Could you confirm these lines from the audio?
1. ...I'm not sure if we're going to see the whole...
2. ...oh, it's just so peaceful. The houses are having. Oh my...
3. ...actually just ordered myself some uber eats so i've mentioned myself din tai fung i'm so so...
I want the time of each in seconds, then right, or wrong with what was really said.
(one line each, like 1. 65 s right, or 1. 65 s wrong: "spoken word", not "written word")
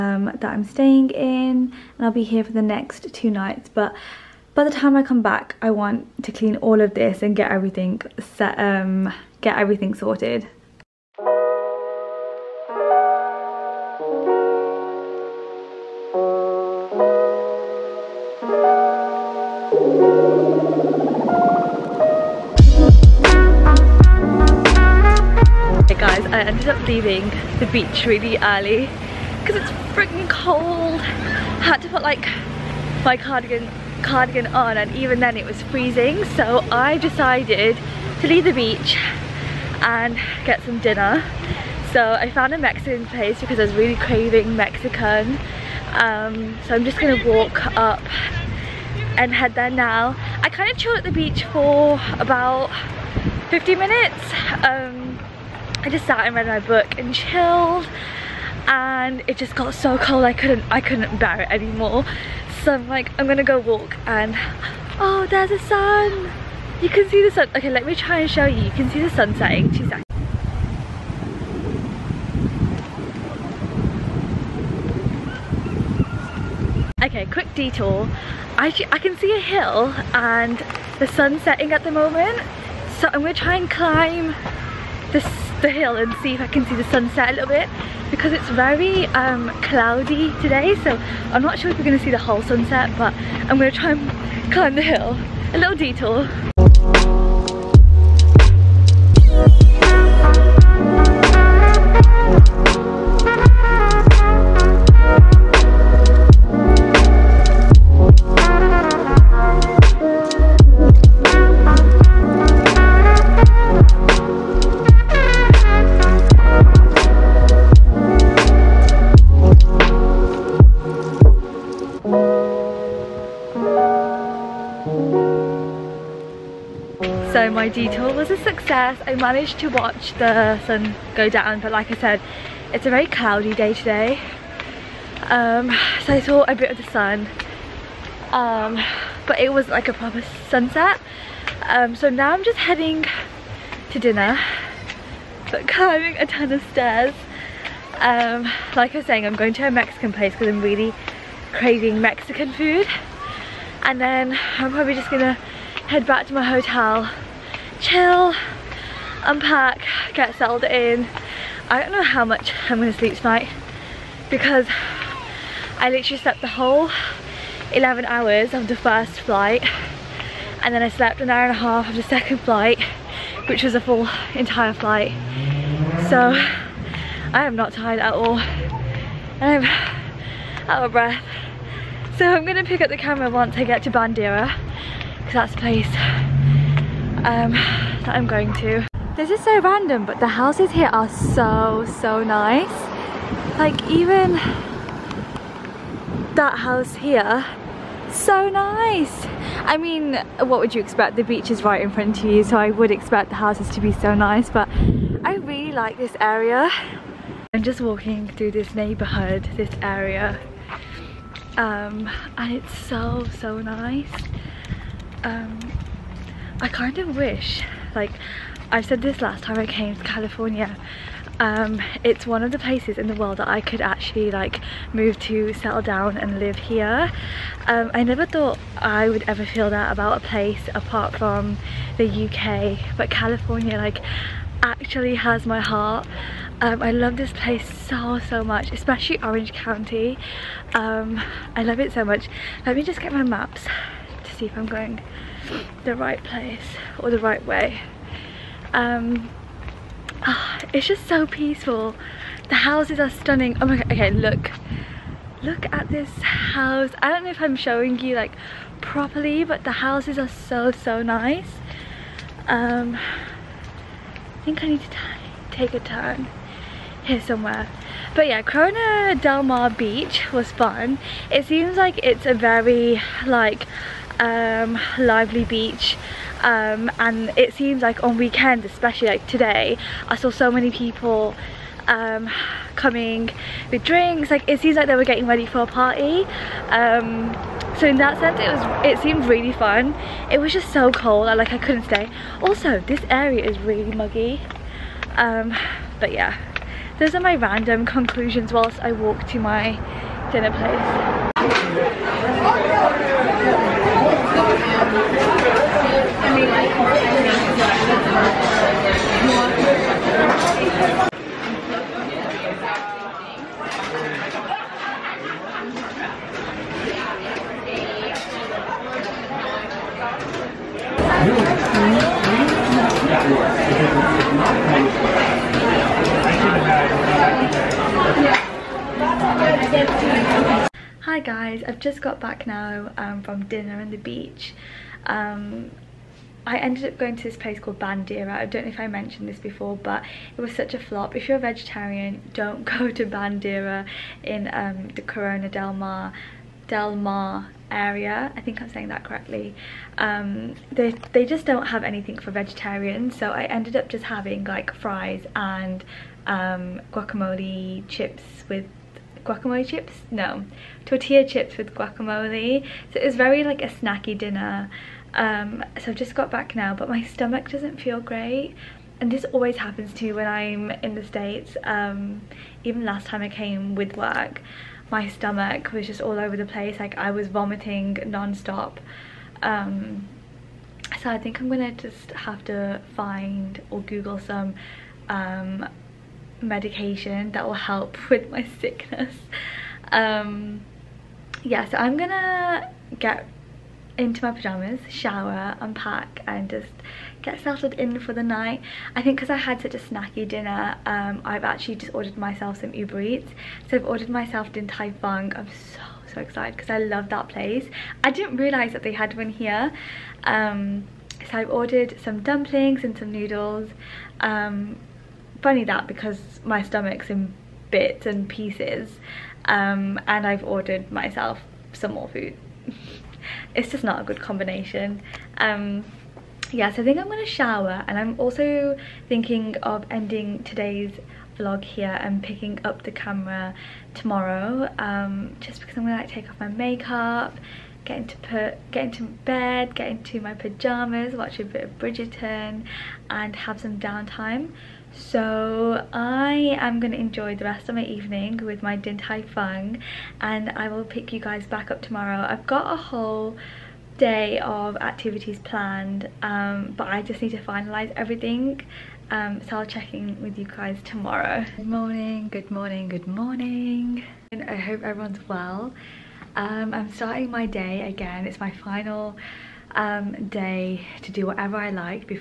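1. 91 s right
2. 250 s wrong: "stunning", not "having"
3. 401 s wrong: "ordered", not "mentioned".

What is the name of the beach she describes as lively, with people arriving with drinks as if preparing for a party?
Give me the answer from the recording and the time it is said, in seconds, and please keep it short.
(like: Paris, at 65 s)
Corona Del Mar Beach, at 268 s.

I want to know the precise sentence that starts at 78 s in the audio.
I, I can see a hill and the sun setting at the moment.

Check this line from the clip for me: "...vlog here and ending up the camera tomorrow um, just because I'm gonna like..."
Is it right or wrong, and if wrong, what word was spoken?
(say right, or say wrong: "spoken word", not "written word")
wrong: "picking", not "ending".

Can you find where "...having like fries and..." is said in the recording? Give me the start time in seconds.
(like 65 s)
354 s.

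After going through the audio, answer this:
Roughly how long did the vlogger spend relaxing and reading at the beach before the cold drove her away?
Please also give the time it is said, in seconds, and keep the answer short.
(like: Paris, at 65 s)
50 minutes, at 53 s.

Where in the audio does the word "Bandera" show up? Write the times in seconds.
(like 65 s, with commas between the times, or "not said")
183 s, 337 s, 343 s.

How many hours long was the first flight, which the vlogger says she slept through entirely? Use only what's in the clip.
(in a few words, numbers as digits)
11.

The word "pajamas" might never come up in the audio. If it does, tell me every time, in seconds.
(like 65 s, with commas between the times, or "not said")
394 s, 440 s.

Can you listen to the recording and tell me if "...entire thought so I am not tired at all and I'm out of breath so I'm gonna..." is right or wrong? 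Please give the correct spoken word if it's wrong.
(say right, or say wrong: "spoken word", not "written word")
wrong: "flight", not "thought".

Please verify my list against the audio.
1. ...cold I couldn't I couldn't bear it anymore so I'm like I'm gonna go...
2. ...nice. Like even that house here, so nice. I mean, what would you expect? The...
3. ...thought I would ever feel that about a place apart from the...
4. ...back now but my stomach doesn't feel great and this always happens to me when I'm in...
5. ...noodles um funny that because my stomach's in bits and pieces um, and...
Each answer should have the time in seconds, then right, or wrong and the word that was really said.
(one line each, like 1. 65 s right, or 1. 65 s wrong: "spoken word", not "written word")
1. 59 s right
2. 192 s right
3. 228 s right
4. 366 s right
5. 413 s right.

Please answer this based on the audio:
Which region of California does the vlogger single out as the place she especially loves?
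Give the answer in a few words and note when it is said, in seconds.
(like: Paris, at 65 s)
Orange County, at 239 s.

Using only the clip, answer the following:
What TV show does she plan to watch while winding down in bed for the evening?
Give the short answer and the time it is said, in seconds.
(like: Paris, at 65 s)
Bridgerton, at 441 s.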